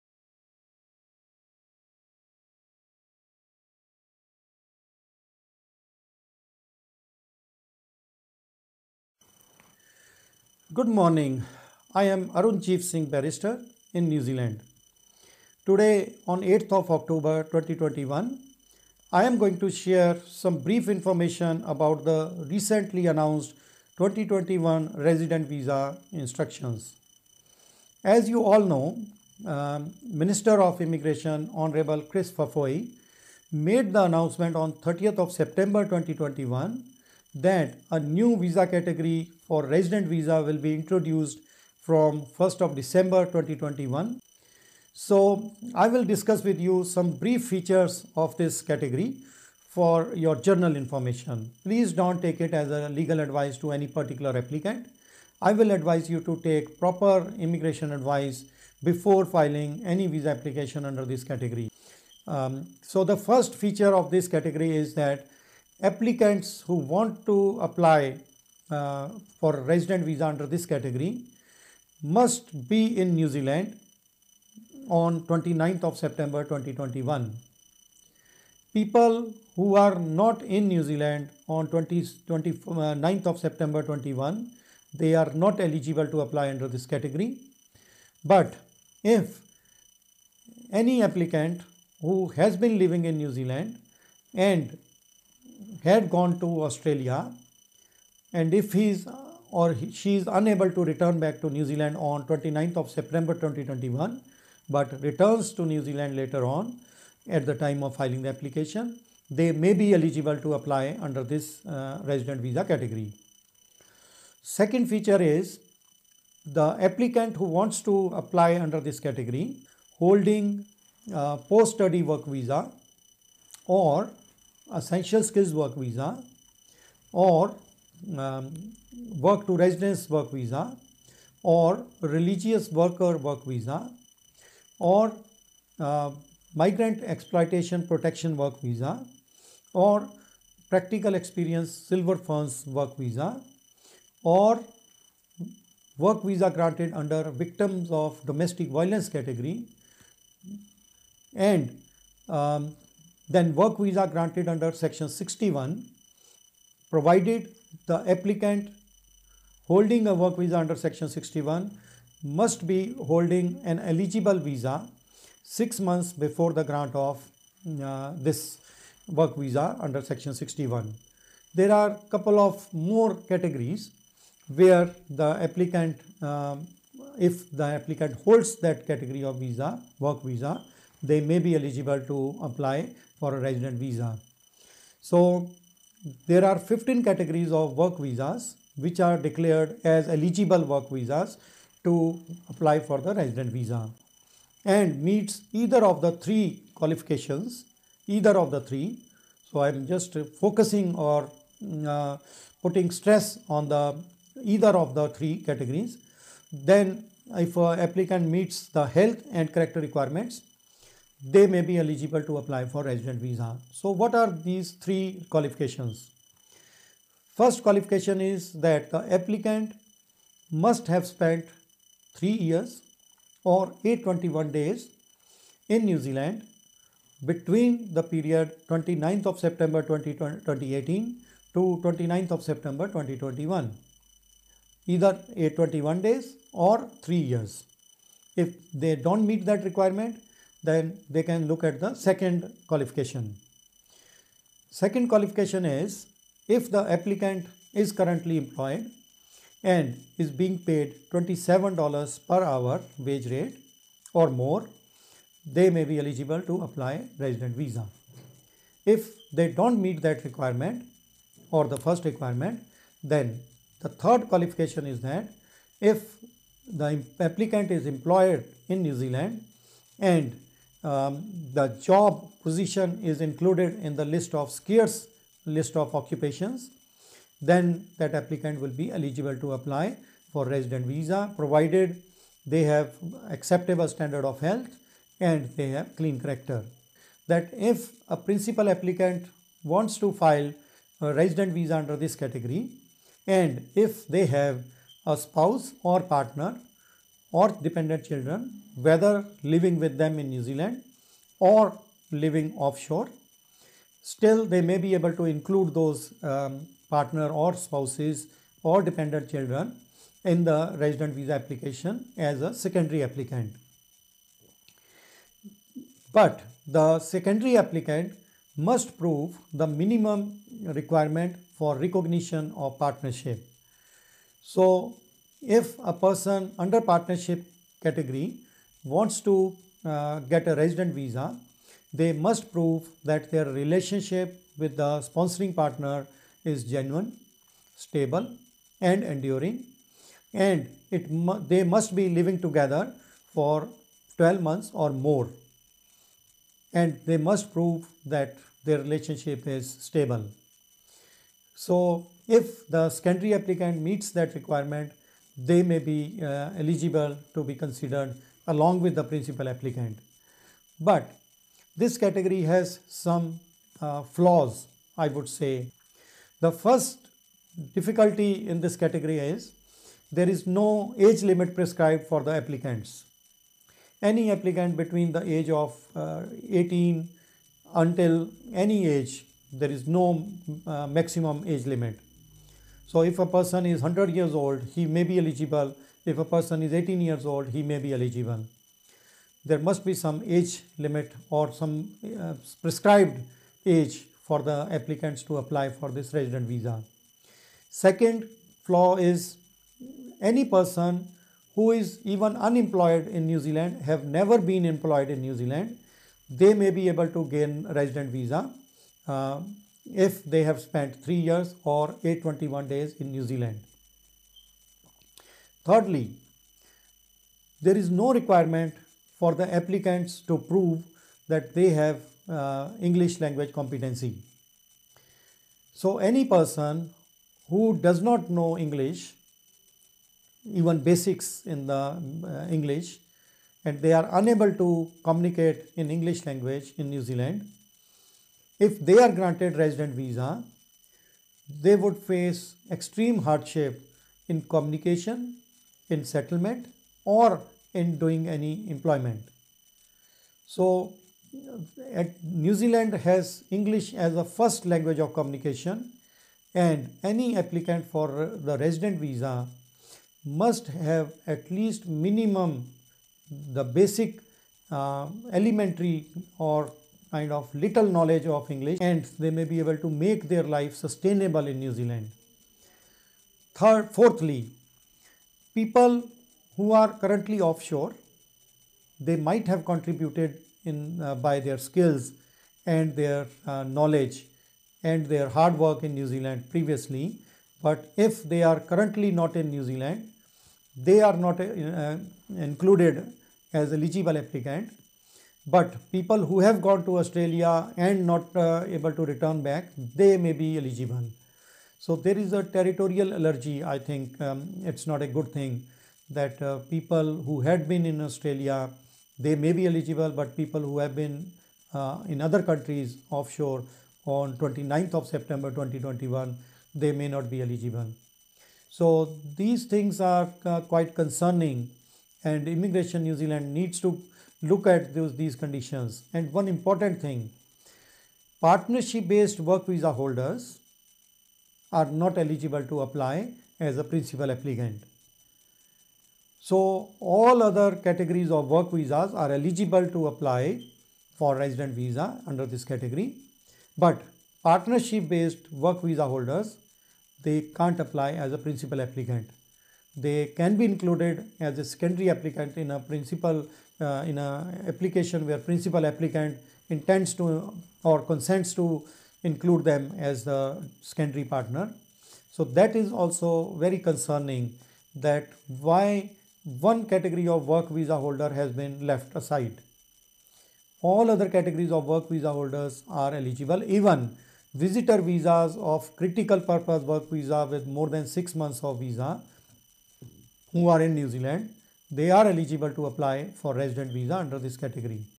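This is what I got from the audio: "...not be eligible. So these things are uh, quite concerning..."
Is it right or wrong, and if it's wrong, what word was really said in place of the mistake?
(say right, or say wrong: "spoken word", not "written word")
right.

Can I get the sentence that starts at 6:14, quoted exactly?
Any applicant between the age of uh, 18 until any age, there is no uh, maximum age limit.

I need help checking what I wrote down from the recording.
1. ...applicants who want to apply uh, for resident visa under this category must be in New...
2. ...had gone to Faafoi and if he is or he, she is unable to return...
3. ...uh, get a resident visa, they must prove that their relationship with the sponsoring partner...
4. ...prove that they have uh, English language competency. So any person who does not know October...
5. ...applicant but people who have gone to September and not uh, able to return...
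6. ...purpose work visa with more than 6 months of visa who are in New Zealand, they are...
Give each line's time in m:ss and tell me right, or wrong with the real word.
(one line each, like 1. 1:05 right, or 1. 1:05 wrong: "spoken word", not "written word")
1. 1:05 right
2. 1:35 wrong: "Australia", not "Faafoi"
3. 5:29 right
4. 7:00 wrong: "English", not "October"
5. 8:14 wrong: "Australia", not "September"
6. 9:36 right.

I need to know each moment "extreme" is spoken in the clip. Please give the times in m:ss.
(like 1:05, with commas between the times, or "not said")
7:22.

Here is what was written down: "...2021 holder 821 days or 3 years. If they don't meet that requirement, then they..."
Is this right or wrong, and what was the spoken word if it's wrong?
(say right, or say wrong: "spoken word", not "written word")
wrong: "either", not "holder".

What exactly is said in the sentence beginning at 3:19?
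So I am just focusing or uh, putting stress on the either of the three categories.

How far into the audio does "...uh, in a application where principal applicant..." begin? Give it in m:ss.
9:13.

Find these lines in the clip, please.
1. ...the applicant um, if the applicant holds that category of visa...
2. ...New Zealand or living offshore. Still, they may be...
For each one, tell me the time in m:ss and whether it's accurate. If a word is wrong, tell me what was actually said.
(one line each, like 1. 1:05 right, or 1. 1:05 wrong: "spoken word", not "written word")
1. 2:55 right
2. 5:00 right.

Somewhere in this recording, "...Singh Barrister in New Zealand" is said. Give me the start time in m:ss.
0:12.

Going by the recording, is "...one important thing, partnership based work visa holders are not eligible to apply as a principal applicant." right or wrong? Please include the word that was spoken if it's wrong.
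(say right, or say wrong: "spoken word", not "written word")
right.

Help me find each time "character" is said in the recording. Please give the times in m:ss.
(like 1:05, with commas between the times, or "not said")
3:29, 4:46.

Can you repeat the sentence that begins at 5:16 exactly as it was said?
But the secondary applicant must prove the minimum requirement for recognition of partnership.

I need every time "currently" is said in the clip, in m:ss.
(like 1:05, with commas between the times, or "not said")
4:07, 7:57, 8:08.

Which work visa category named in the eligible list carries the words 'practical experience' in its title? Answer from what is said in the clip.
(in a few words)
Silver Ferns.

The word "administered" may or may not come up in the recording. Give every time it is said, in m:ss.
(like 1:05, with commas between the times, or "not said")
not said.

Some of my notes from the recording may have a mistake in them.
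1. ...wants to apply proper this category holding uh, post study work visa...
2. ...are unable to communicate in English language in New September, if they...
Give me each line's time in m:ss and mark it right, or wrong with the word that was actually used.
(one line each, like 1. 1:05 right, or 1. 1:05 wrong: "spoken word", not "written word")
1. 1:57 wrong: "under", not "proper"
2. 7:13 wrong: "Zealand", not "September".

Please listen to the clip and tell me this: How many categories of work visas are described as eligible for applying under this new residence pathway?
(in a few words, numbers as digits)
15.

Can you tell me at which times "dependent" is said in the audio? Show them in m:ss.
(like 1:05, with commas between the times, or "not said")
4:57, 5:08.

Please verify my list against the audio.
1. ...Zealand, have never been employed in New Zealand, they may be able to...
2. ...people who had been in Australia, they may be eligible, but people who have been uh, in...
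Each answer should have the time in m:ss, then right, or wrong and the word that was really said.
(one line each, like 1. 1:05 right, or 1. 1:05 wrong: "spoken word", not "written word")
1. 6:43 right
2. 8:26 right.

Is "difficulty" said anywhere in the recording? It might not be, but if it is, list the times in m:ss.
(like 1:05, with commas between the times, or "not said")
6:07.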